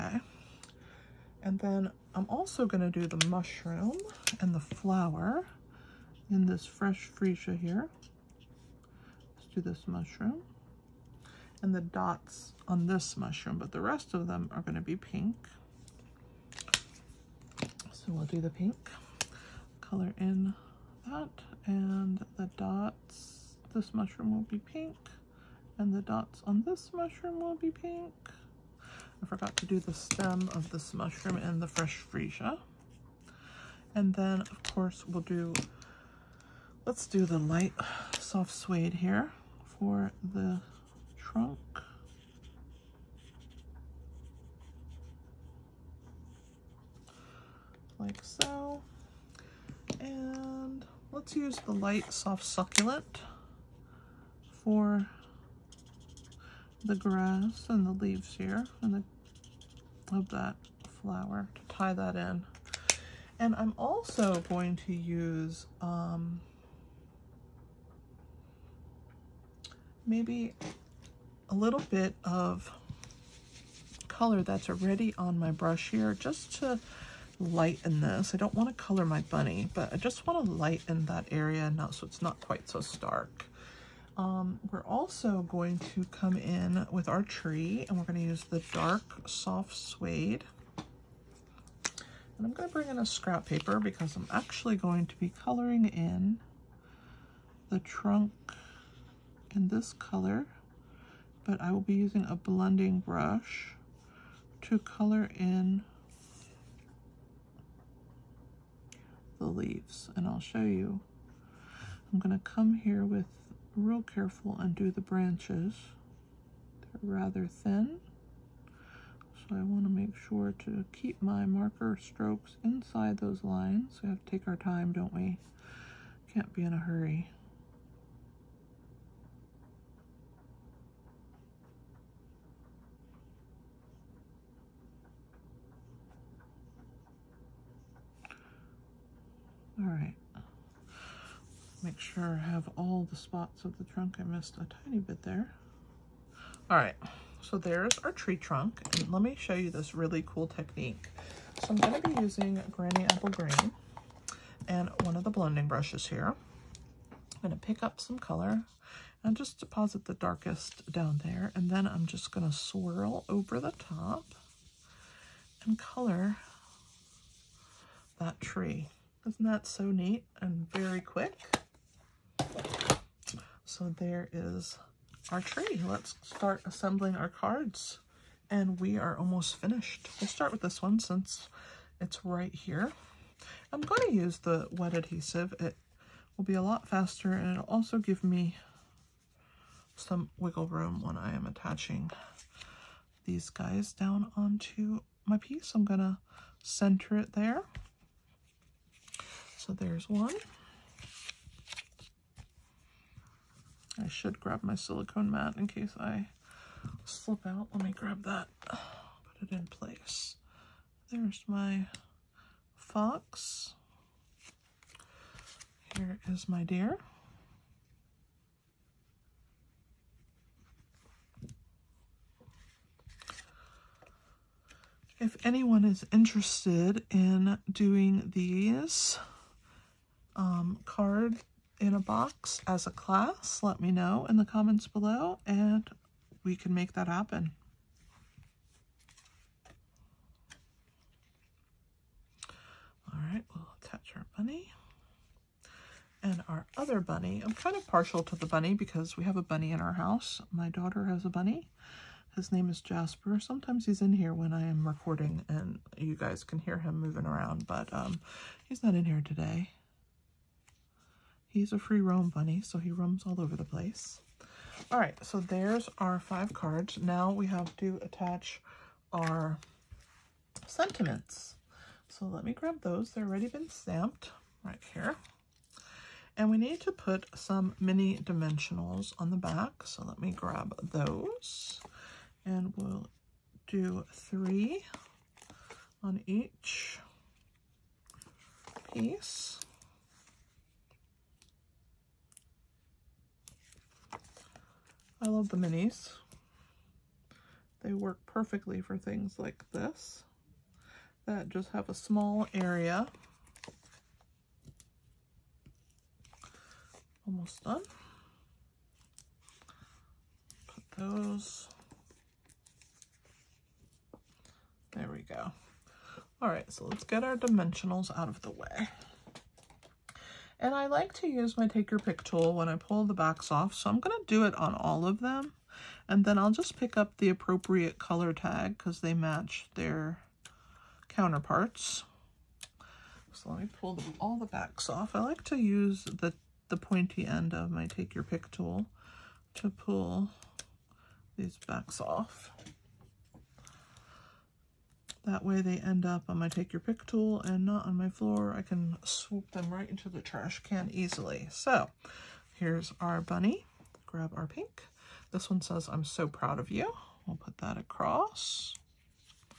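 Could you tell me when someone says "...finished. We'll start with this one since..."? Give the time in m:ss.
2:59.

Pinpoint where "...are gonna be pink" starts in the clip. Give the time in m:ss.
0:14.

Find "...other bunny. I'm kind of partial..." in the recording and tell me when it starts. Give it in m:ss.
4:06.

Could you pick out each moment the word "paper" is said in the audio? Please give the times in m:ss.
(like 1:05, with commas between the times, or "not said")
1:33.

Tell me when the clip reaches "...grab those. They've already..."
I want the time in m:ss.
4:32.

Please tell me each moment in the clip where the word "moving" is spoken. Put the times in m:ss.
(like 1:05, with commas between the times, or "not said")
4:17.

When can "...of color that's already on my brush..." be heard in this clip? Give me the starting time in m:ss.
1:12.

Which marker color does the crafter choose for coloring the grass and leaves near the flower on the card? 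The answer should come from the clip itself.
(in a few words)
light soft succulent.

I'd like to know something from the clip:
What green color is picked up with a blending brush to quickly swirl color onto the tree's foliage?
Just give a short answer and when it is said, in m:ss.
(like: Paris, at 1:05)
Granny Apple Green, at 2:32.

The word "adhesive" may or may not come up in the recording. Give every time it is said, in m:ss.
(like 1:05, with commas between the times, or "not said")
3:04.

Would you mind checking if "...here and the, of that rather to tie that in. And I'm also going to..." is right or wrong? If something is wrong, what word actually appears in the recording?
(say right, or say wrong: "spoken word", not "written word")
wrong: "flower", not "rather".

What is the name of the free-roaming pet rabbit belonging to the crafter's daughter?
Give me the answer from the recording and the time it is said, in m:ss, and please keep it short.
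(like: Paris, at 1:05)
Jasper, at 4:12.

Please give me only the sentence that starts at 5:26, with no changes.
And then I'll just pick up the appropriate color tag because they match their counterparts.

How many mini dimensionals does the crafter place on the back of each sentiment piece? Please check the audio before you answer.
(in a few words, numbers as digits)
3.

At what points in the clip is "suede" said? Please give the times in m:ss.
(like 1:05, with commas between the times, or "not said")
0:38, 1:29.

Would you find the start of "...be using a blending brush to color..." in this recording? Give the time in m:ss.
1:41.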